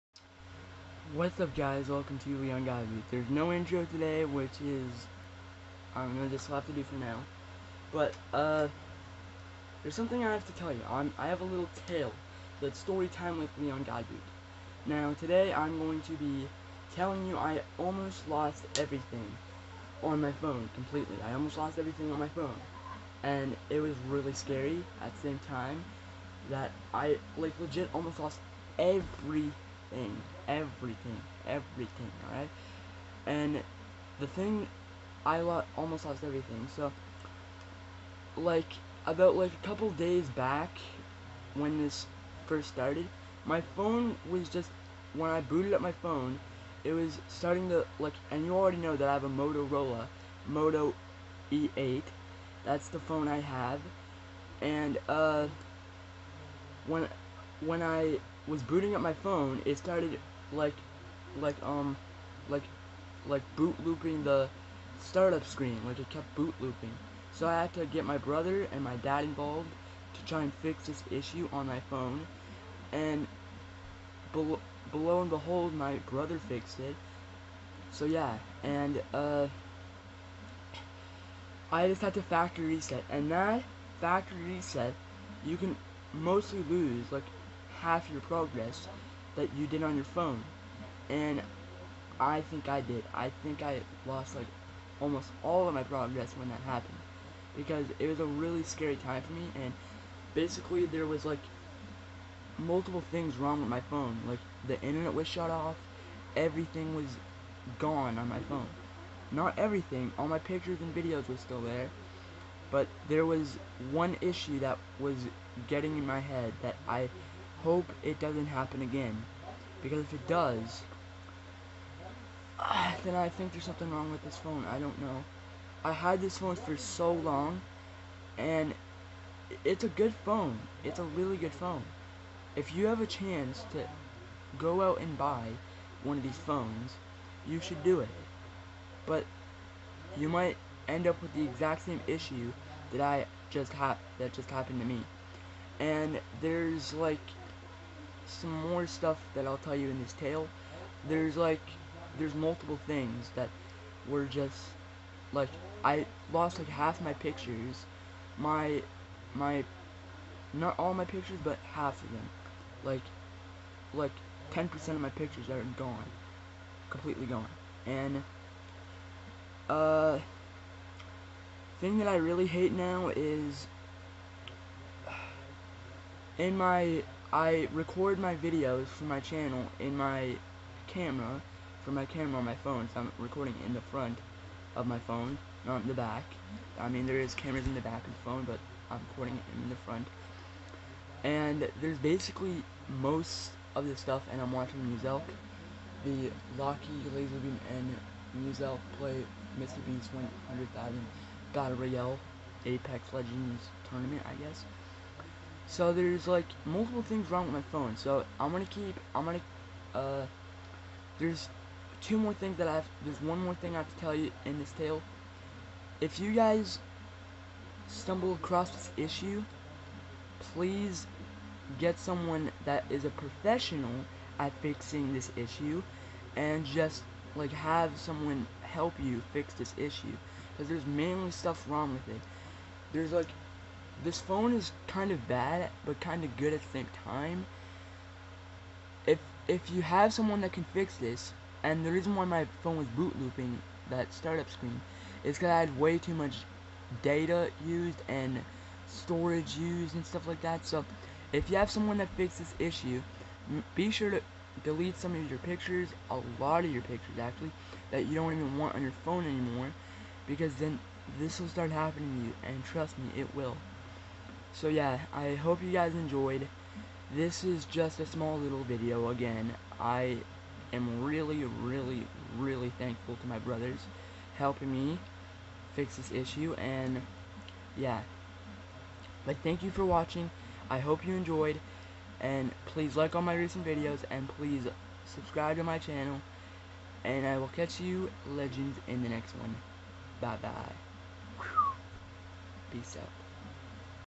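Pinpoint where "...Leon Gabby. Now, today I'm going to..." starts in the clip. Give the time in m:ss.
0:13.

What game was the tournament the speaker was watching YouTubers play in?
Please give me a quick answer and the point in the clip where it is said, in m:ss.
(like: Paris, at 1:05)
Apex Legends, at 3:22.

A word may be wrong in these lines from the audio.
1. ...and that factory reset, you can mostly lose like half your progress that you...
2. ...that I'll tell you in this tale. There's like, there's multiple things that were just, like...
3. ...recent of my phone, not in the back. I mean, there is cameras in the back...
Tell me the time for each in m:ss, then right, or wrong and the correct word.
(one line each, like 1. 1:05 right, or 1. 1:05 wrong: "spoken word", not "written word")
1. 1:23 right
2. 2:29 right
3. 3:03 wrong: "front", not "recent".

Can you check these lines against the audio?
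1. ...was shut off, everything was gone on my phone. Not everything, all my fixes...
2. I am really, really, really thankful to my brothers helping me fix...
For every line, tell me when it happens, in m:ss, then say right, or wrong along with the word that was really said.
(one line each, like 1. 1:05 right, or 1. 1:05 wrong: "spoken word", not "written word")
1. 1:45 wrong: "pictures", not "fixes"
2. 4:29 right.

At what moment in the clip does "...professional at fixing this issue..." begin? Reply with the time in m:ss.
3:43.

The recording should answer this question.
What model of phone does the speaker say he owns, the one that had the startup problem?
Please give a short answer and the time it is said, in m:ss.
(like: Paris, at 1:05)
Moto E8, at 0:50.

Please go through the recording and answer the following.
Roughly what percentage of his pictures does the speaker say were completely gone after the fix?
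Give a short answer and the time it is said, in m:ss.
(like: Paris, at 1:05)
10%, at 2:44.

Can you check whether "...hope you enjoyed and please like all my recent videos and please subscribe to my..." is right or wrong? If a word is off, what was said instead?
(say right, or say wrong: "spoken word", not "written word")
right.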